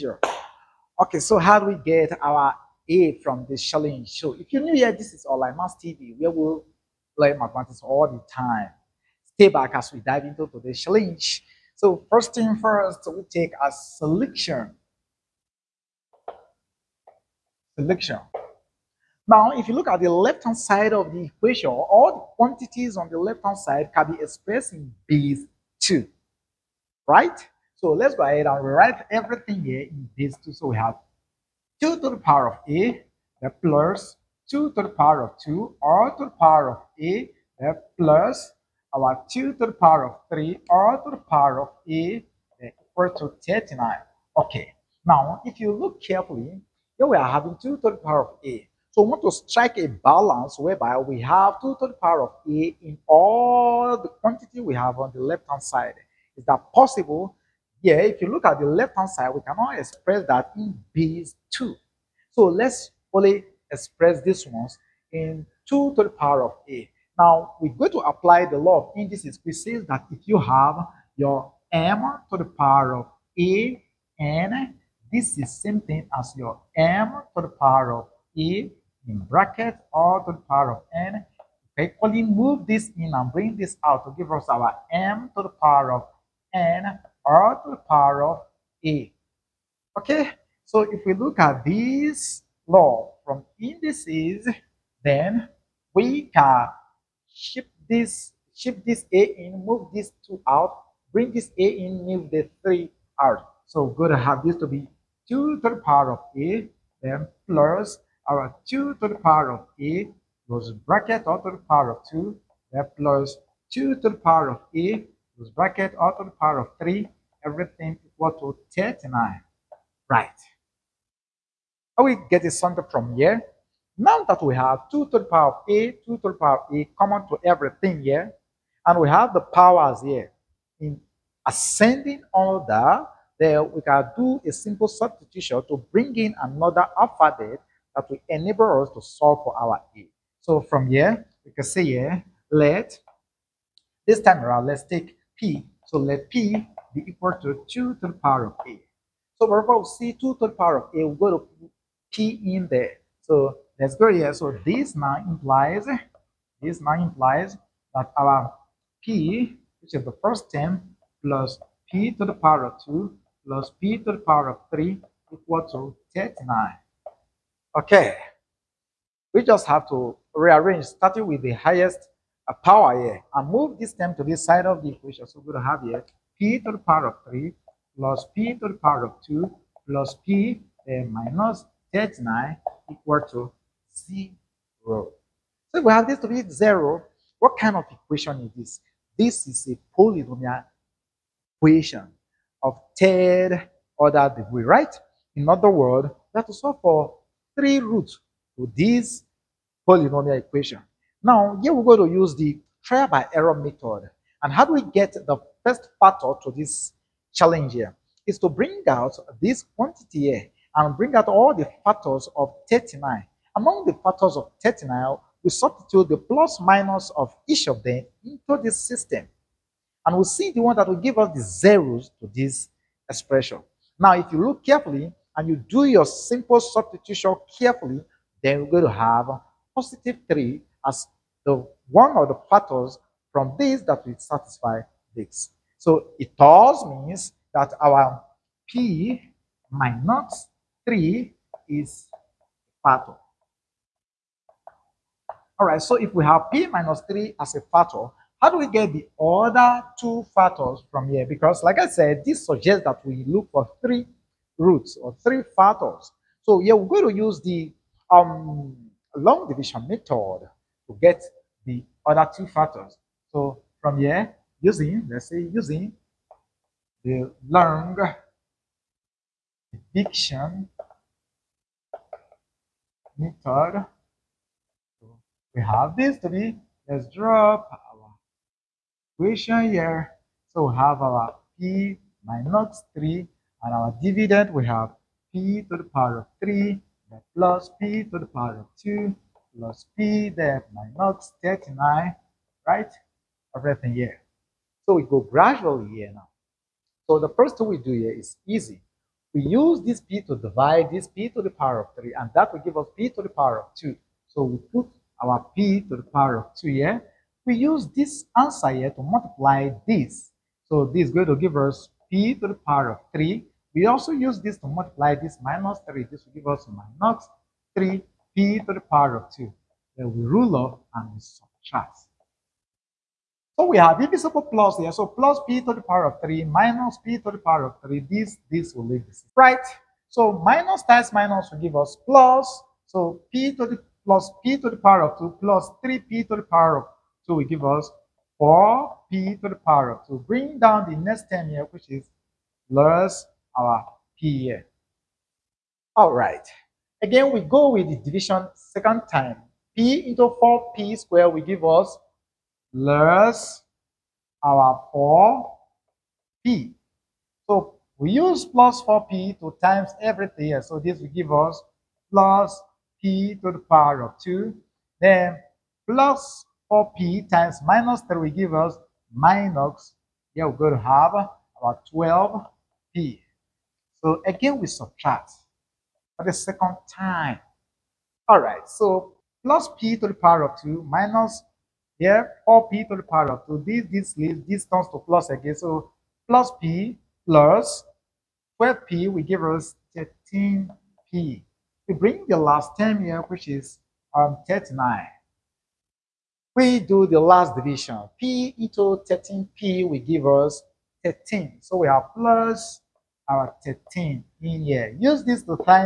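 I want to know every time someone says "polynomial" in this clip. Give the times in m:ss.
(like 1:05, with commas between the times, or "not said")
3:09, 3:19.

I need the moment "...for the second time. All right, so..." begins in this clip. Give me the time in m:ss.
6:16.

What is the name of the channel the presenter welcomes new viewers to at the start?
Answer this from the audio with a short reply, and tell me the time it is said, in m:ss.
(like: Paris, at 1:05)
OnlineMaths TV, at 0:05.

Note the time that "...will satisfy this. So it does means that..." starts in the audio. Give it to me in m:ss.
3:54.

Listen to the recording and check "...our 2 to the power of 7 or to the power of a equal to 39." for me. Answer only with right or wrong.
wrong.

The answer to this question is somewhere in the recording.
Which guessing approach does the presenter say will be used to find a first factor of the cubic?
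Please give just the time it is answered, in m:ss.
3:22.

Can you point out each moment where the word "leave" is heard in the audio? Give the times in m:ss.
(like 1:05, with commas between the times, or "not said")
5:28, 6:24.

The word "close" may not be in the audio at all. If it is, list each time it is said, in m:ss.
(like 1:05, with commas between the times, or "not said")
1:50.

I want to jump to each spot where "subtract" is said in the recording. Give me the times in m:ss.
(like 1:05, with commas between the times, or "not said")
5:21, 6:14.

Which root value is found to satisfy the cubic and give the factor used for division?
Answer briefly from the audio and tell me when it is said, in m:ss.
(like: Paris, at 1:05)
3, at 3:49.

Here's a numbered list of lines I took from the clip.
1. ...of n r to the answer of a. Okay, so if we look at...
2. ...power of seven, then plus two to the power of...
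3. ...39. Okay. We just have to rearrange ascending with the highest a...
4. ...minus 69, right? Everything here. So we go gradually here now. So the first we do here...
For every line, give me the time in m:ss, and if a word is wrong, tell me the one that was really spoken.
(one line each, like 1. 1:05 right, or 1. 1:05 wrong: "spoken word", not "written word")
1. 1:25 wrong: "power", not "answer"
2. 1:51 wrong: "two", not "seven"
3. 2:46 wrong: "starting", not "ascending"
4. 4:50 wrong: "39", not "69".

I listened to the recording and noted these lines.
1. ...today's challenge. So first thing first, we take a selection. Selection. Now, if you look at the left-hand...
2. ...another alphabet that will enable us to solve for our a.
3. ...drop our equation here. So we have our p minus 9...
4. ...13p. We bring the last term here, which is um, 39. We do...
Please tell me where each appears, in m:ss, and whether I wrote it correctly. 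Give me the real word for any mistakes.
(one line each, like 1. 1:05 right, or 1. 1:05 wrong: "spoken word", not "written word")
1. 0:10 right
2. 2:16 right
3. 4:37 wrong: "3", not "9"
4. 6:29 right.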